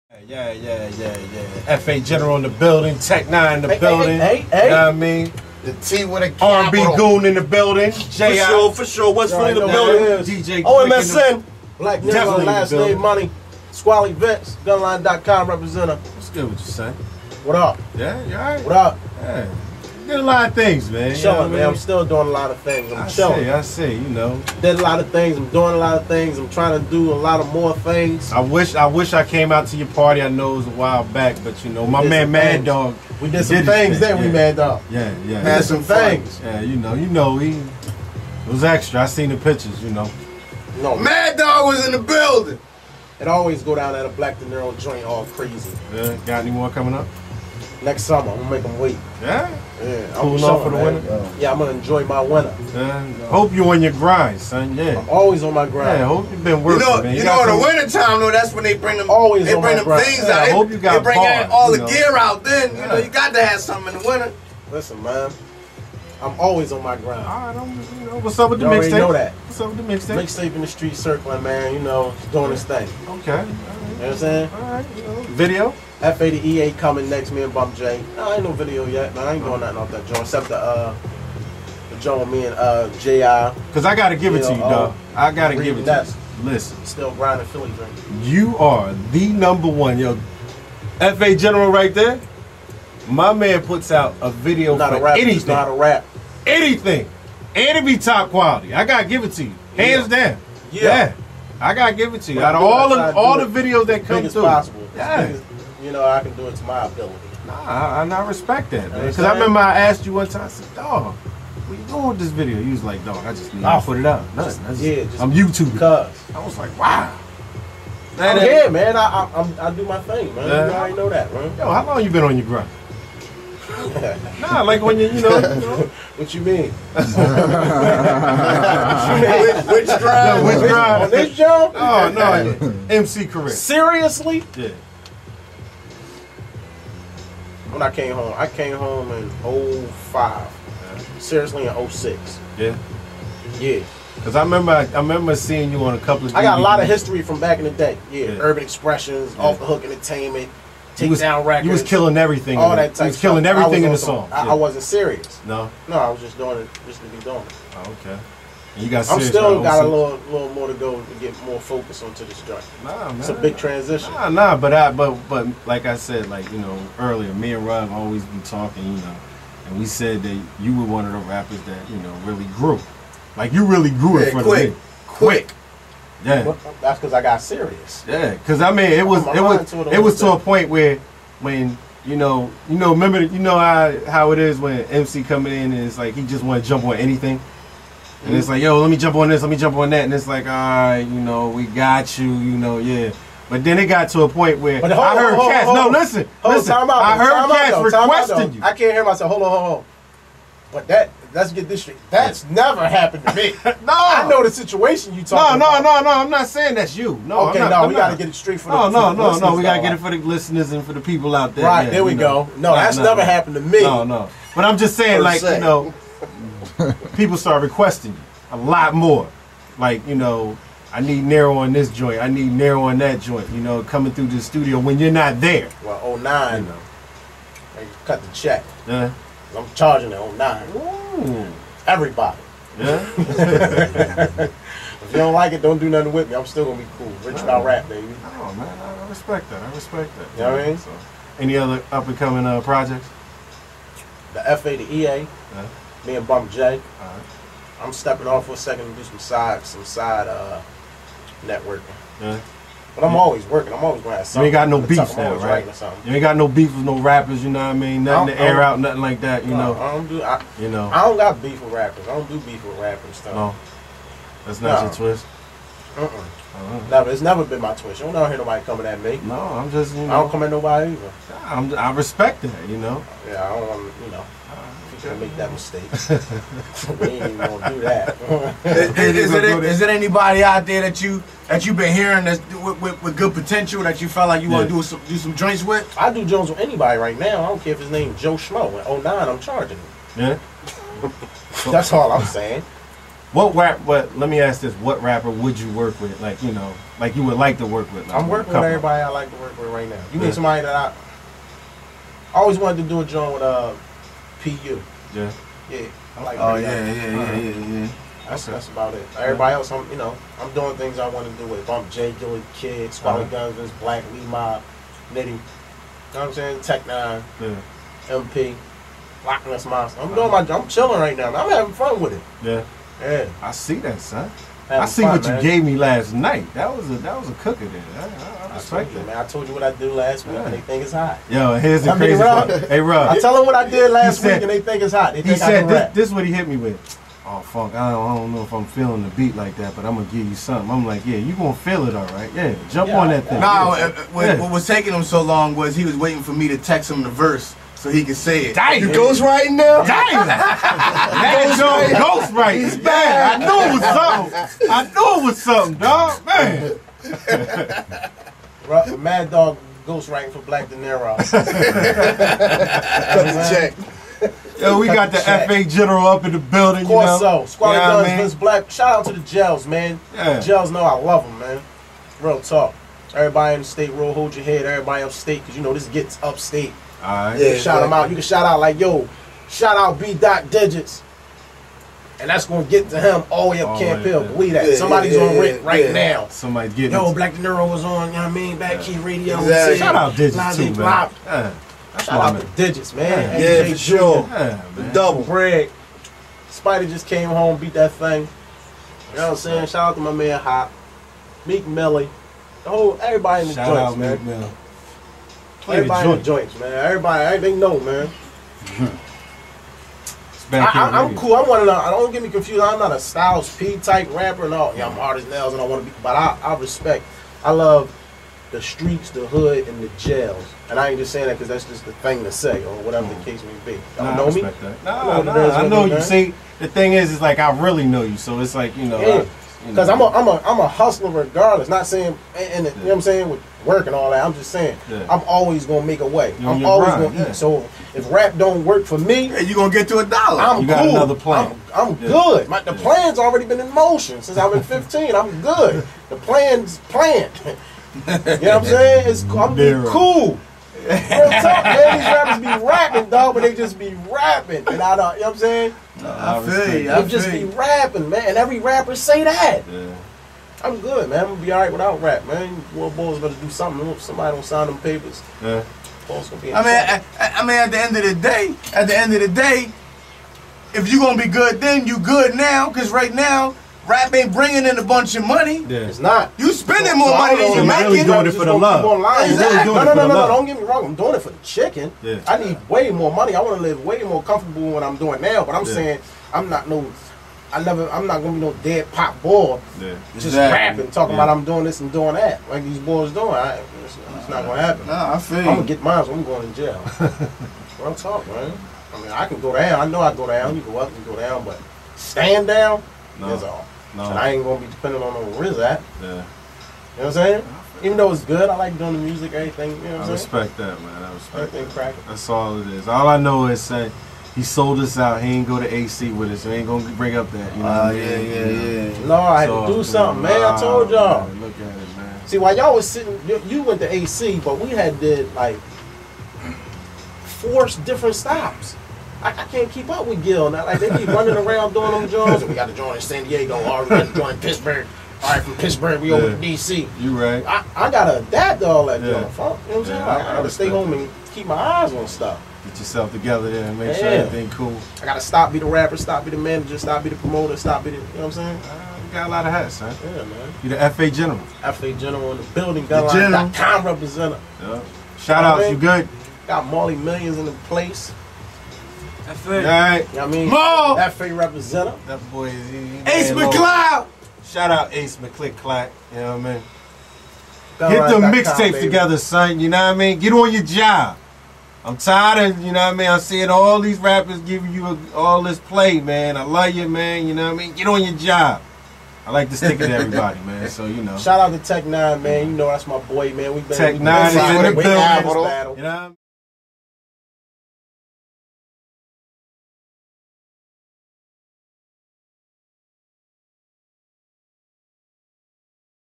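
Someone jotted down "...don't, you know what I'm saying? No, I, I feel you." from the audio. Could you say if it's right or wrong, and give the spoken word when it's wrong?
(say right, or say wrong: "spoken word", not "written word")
right.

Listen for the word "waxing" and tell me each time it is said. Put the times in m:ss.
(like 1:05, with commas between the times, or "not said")
not said.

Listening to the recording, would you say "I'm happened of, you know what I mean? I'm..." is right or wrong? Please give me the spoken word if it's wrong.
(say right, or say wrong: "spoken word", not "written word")
wrong: "tired", not "happened".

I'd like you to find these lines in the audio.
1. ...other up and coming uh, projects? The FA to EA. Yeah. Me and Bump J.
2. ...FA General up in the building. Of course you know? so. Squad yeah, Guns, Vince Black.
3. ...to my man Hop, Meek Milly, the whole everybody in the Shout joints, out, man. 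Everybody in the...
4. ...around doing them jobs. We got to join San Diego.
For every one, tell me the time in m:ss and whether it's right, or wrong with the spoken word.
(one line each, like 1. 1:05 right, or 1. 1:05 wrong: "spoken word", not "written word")
1. 4:01 right
2. 6:05 right
3. 6:39 right
4. 8:51 right.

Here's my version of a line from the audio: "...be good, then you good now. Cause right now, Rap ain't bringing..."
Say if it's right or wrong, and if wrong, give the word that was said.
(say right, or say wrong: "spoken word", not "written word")
right.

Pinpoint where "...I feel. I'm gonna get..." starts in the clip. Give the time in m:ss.
8:15.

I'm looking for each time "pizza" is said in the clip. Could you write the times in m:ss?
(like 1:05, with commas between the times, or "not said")
not said.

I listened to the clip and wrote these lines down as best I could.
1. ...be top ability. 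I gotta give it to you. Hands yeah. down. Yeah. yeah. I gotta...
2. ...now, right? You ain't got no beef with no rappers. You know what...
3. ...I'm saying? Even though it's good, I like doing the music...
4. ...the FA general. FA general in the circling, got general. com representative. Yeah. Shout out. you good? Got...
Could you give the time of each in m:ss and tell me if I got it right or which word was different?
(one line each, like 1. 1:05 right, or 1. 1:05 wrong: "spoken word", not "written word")
1. 1:37 wrong: "quality", not "ability"
2. 4:15 right
3. 8:27 right
4. 9:10 wrong: "building", not "circling".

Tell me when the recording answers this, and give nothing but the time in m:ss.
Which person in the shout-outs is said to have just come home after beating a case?
6:36.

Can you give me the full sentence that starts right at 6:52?
I'm not a Styles P type rapper no.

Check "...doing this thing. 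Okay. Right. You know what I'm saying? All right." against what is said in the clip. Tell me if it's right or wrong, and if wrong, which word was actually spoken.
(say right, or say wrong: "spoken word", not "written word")
right.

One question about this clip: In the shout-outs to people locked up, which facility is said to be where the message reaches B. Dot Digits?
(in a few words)
Camp Hill.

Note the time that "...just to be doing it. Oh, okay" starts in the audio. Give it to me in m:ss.
2:36.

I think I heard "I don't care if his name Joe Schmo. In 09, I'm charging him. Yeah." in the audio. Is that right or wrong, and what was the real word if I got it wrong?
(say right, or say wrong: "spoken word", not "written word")
right.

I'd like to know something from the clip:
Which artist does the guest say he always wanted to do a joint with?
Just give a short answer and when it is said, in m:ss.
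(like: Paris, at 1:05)
PU, at 5:04.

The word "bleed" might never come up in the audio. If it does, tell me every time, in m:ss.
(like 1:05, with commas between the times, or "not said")
not said.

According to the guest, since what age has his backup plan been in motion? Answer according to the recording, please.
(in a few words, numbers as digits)
15.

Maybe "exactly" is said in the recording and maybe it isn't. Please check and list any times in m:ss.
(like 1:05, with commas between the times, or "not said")
6:29, 7:59, 8:10.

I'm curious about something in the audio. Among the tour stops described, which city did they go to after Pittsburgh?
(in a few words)
DC.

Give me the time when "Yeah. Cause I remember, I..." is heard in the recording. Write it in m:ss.
2:23.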